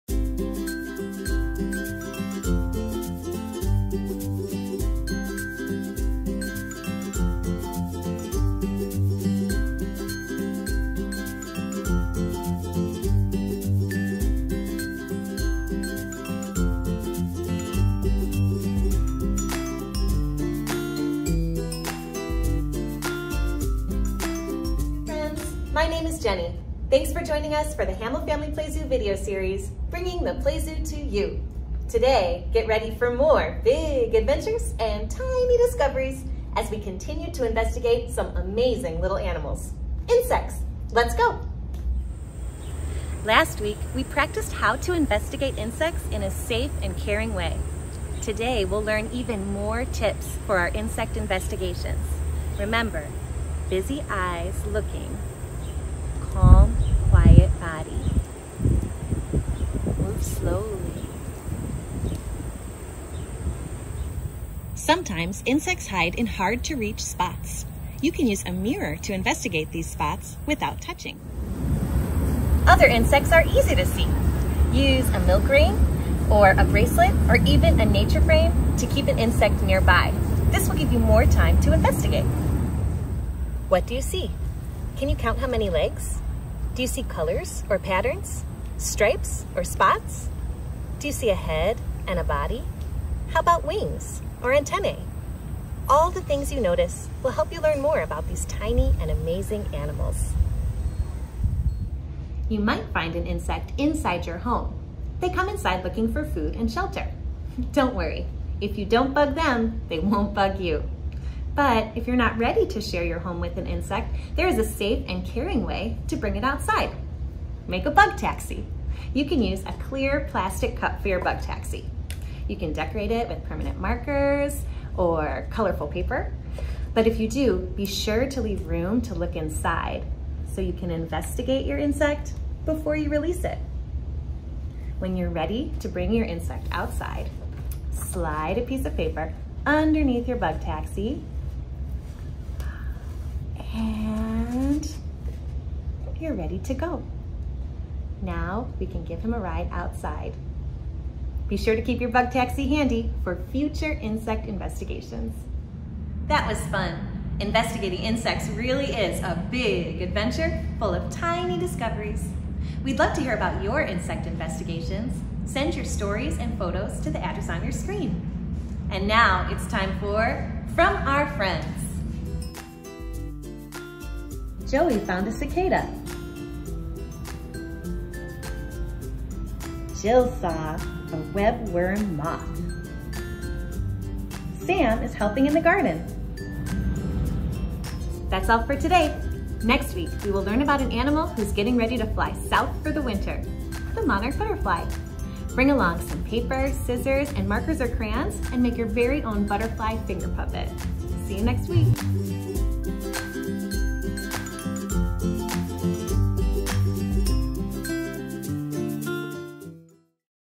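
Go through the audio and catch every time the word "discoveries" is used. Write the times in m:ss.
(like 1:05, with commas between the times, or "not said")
0:35, 2:41.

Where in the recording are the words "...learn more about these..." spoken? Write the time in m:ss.
1:37.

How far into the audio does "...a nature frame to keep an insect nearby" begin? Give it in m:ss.
1:17.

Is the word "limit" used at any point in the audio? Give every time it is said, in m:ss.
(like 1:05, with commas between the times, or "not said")
not said.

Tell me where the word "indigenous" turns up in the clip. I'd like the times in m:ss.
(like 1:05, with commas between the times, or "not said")
not said.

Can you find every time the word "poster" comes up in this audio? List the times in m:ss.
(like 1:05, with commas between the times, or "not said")
not said.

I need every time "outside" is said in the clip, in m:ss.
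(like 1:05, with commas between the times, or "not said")
1:56, 2:16, 2:29.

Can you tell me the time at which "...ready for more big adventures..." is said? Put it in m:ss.
0:32.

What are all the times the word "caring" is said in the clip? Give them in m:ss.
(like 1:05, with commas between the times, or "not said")
0:46, 1:55.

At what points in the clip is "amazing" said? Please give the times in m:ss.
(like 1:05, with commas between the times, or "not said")
0:38, 1:39.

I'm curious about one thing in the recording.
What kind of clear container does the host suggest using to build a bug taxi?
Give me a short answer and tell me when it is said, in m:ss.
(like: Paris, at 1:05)
clear plastic cup, at 1:59.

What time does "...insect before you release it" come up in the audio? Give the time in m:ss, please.
2:11.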